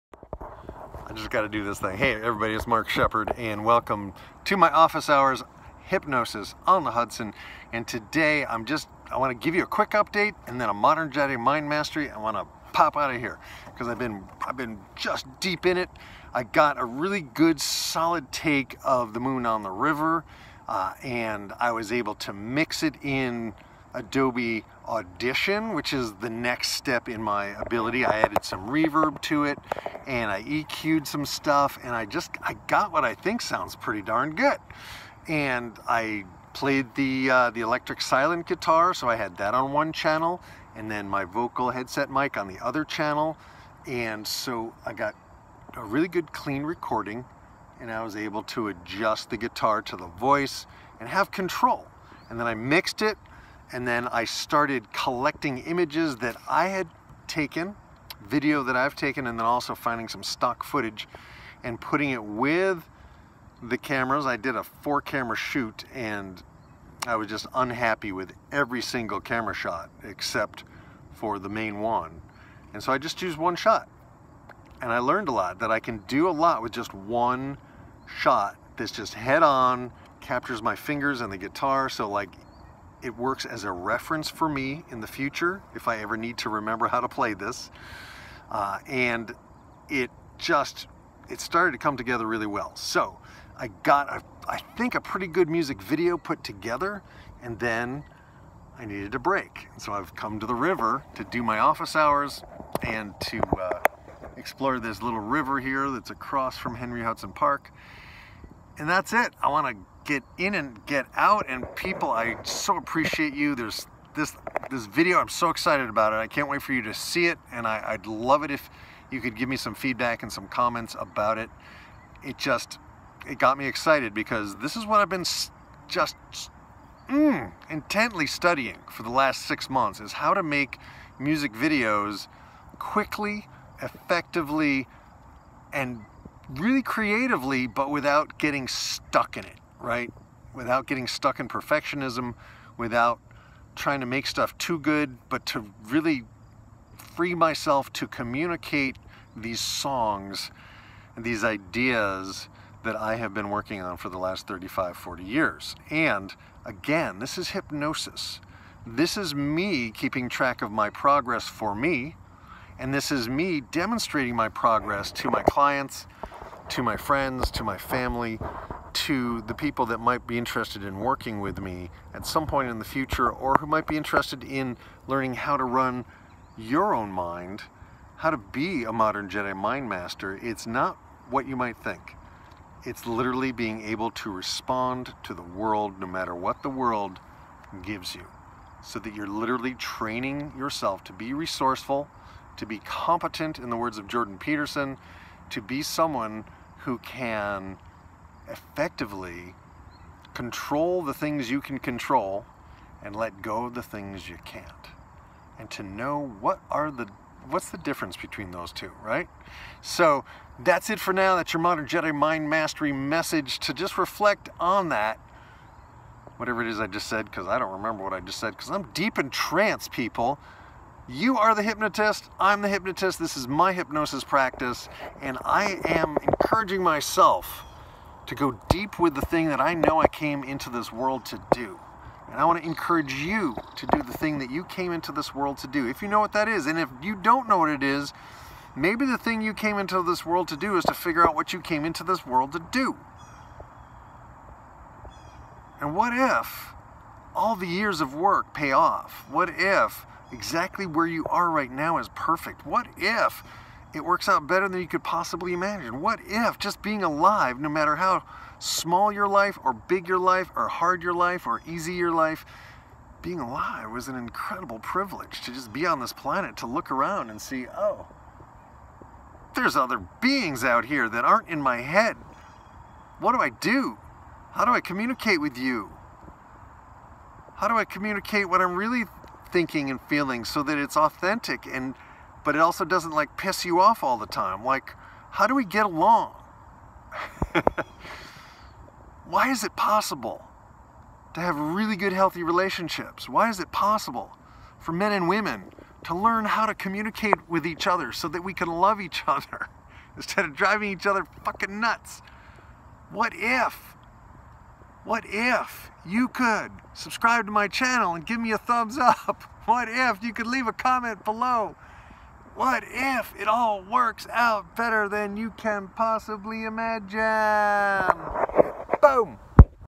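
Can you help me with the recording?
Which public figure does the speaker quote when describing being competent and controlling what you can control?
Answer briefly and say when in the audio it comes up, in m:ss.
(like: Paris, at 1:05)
Jordan Peterson, at 3:14.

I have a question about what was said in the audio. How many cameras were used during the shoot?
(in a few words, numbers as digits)
4.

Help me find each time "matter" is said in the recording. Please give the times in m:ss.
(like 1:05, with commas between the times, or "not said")
3:06, 4:17.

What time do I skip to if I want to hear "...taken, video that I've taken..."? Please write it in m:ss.
0:57.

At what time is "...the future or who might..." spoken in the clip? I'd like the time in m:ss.
2:52.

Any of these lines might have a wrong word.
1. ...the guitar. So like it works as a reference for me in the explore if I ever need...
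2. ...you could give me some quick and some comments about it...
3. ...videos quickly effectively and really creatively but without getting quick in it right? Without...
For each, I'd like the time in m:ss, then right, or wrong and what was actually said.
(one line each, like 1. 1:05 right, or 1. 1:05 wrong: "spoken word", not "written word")
1. 1:21 wrong: "future", not "explore"
2. 1:59 wrong: "feedback", not "quick"
3. 2:11 wrong: "stuck", not "quick".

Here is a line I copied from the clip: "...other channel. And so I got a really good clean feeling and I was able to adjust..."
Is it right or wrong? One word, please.
wrong.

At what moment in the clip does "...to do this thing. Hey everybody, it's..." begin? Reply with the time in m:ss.
0:01.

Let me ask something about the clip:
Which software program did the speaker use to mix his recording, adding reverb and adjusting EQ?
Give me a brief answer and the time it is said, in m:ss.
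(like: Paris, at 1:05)
Adobe Audition, at 0:23.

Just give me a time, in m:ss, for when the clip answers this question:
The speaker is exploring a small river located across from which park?
1:46.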